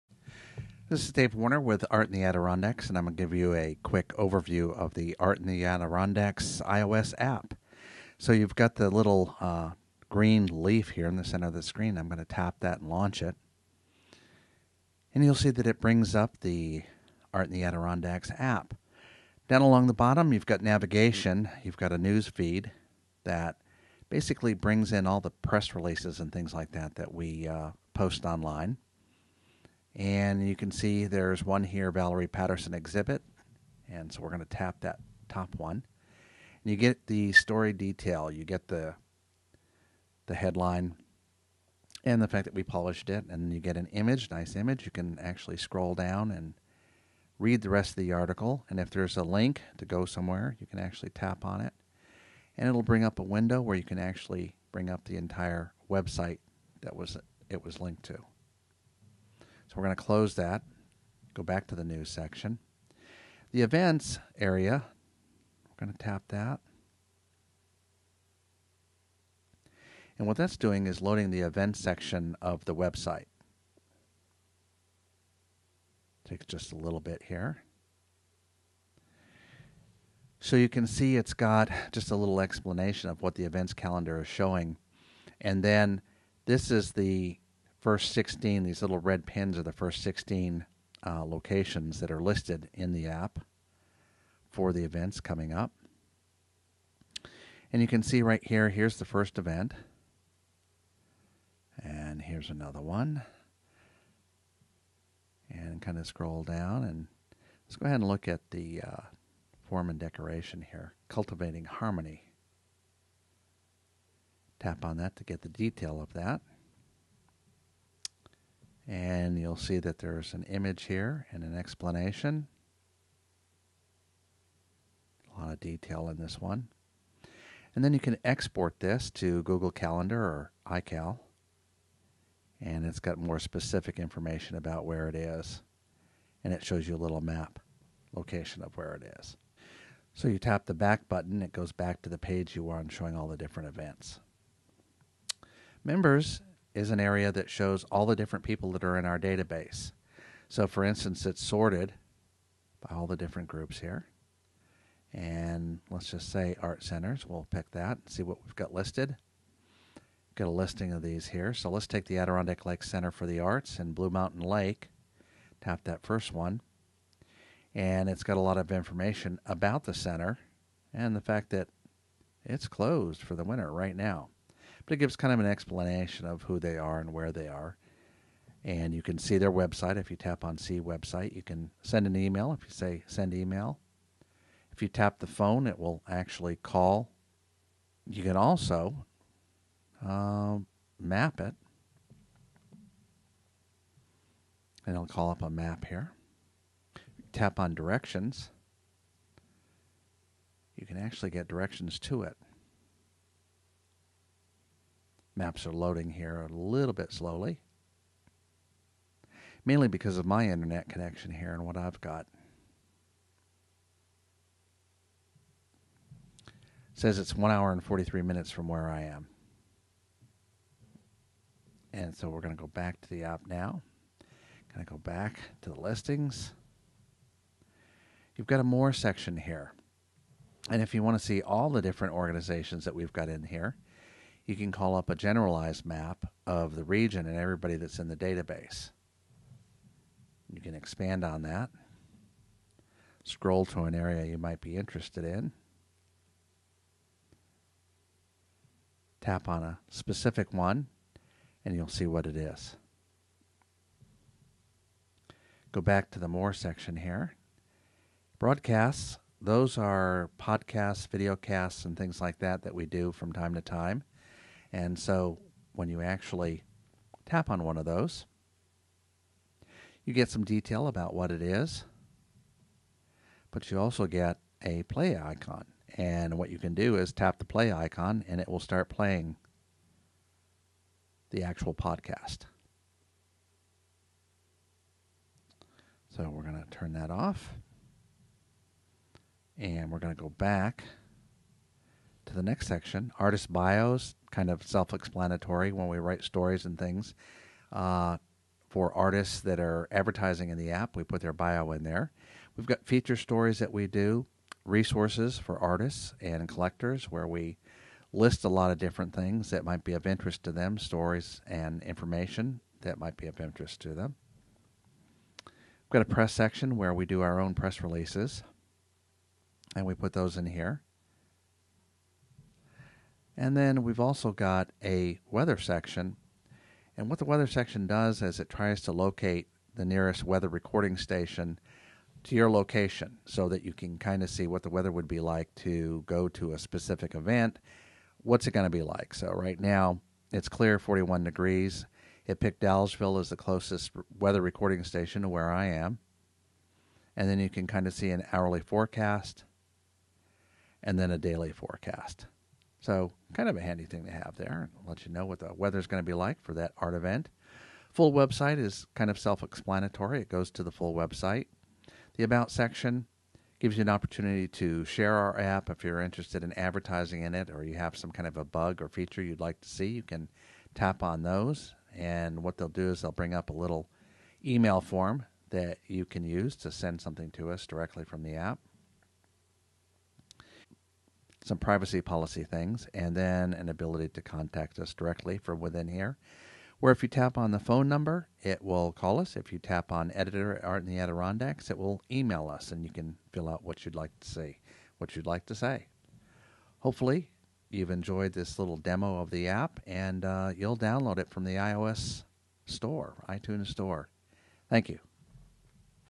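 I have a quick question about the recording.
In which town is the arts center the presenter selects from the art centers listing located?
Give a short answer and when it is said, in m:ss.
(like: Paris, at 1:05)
Blue Mountain Lake, at 2:43.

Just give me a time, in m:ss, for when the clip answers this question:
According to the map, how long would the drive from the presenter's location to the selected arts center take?
3:37.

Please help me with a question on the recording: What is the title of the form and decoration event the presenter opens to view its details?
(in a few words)
Cultivating Harmony.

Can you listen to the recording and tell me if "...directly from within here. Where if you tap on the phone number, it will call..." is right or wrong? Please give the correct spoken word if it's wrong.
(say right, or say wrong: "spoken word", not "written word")
right.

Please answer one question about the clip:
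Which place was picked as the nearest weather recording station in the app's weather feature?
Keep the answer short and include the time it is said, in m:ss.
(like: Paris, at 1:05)
Dallasville, at 5:42.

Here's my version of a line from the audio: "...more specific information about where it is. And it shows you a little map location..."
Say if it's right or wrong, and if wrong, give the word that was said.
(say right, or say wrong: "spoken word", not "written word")
right.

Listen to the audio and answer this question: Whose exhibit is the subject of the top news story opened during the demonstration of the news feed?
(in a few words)
Valerie Patterson.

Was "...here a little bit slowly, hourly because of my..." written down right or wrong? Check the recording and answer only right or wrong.
wrong.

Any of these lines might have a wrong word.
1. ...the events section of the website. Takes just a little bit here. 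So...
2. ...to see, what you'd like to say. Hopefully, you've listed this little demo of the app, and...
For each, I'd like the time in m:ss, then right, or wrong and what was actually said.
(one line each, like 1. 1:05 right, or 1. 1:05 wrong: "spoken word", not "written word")
1. 1:11 right
2. 6:34 wrong: "enjoyed", not "listed".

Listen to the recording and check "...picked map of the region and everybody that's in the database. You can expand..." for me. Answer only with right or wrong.
wrong.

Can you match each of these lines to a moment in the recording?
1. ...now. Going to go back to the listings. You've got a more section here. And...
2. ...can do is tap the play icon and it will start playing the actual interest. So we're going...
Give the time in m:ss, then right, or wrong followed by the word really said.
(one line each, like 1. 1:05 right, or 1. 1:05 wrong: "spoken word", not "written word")
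1. 3:43 right
2. 4:36 wrong: "podcast", not "interest".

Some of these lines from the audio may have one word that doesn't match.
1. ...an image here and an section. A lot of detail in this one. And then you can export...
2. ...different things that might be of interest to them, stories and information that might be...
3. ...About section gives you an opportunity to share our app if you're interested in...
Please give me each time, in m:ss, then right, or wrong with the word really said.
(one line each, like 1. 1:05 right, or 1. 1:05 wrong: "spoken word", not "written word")
1. 2:00 wrong: "explanation", not "section"
2. 5:08 right
3. 6:02 right.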